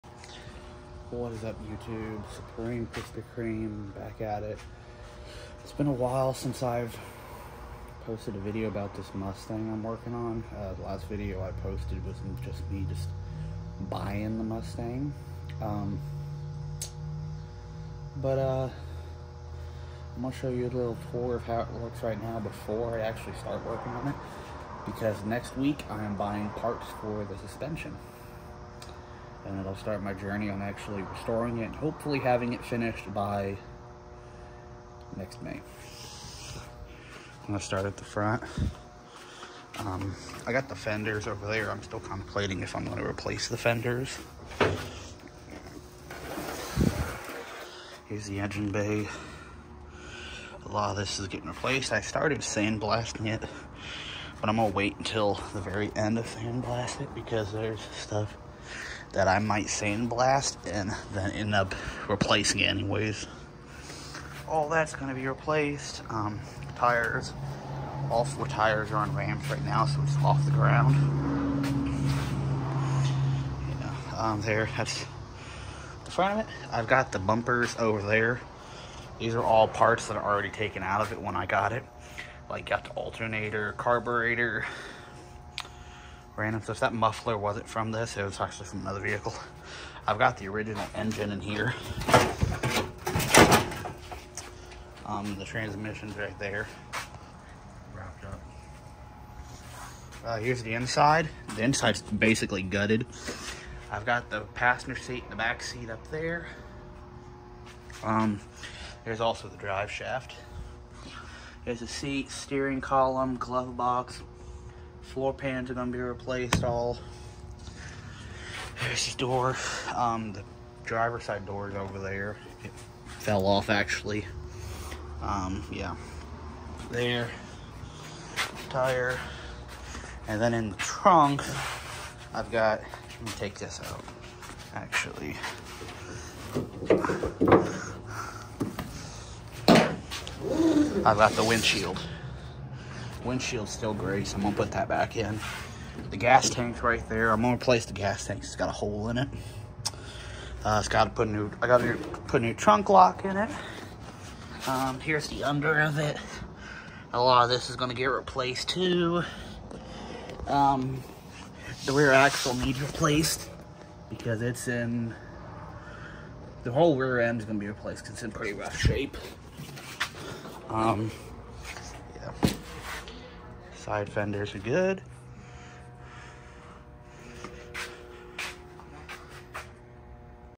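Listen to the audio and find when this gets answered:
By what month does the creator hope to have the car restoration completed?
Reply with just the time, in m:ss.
0:35.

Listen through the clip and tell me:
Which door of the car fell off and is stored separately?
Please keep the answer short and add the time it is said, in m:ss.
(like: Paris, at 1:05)
Driver's side door, at 2:00.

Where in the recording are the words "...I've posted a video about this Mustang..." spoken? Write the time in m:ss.
0:06.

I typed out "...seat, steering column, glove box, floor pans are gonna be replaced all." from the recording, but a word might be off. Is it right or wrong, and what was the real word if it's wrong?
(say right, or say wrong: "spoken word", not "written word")
right.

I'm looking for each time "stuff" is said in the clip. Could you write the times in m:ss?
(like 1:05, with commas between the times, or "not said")
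0:57, 1:26.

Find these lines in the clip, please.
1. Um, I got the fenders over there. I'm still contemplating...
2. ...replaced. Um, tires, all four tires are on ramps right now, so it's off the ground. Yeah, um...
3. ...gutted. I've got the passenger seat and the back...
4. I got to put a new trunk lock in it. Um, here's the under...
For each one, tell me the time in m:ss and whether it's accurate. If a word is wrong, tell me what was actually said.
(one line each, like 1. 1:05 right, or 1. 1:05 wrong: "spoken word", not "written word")
1. 0:39 right
2. 1:05 right
3. 1:42 right
4. 2:31 right.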